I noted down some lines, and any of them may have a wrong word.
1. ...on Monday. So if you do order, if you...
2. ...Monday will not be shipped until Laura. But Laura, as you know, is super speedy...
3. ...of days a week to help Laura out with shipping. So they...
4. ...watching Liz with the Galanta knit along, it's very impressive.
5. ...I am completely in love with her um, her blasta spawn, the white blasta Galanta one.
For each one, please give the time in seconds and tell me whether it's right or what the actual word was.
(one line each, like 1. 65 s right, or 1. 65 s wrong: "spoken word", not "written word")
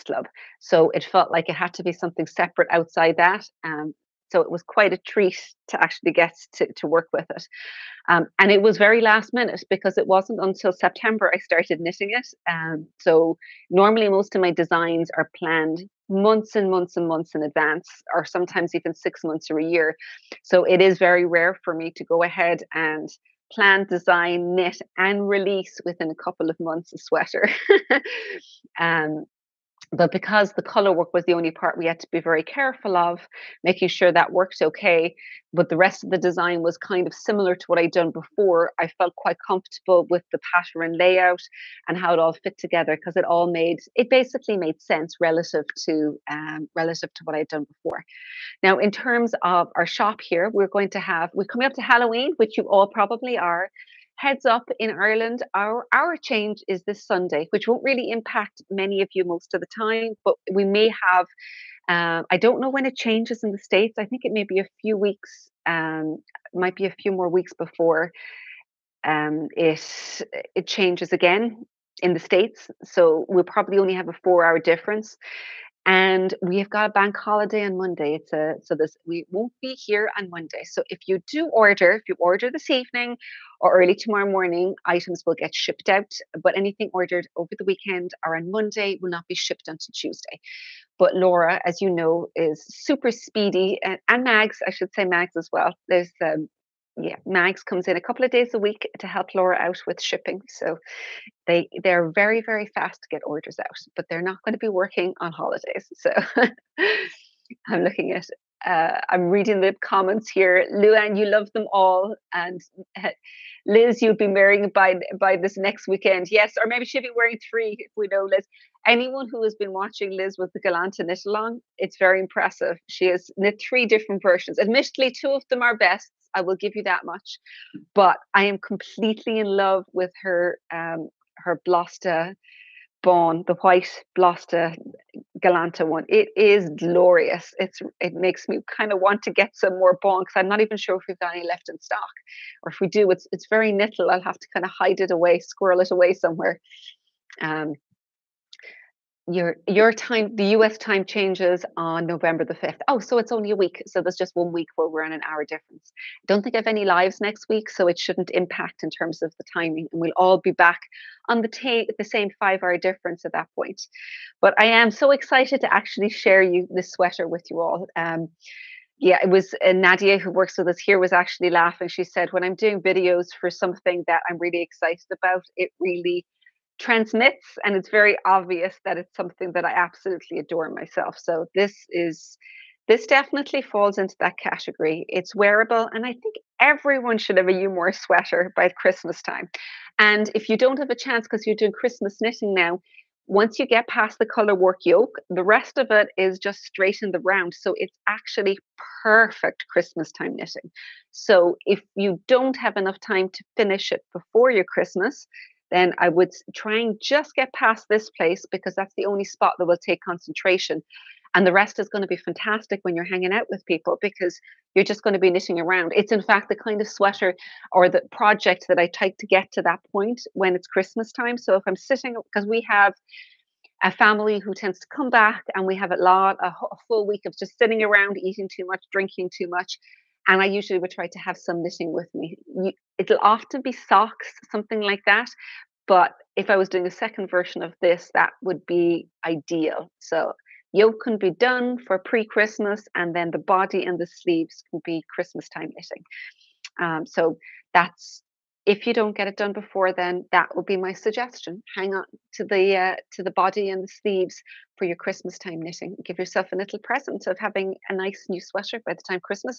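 1. 80 s right
2. 88 s wrong: "Tuesday", not "Laura"
3. 98 s right
4. 119 s right
5. 128 s right.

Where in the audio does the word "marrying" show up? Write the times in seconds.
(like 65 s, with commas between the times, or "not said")
114 s.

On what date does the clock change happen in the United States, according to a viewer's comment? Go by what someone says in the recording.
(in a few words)
November 5th.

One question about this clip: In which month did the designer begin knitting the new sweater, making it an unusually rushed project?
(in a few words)
September.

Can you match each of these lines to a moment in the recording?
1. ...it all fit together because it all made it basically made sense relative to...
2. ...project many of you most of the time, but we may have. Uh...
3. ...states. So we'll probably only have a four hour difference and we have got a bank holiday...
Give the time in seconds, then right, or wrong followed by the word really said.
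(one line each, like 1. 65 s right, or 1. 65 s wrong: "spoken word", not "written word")
1. 42 s right
2. 58 s wrong: "impact", not "project"
3. 72 s right.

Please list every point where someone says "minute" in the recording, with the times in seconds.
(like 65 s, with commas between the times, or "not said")
9 s.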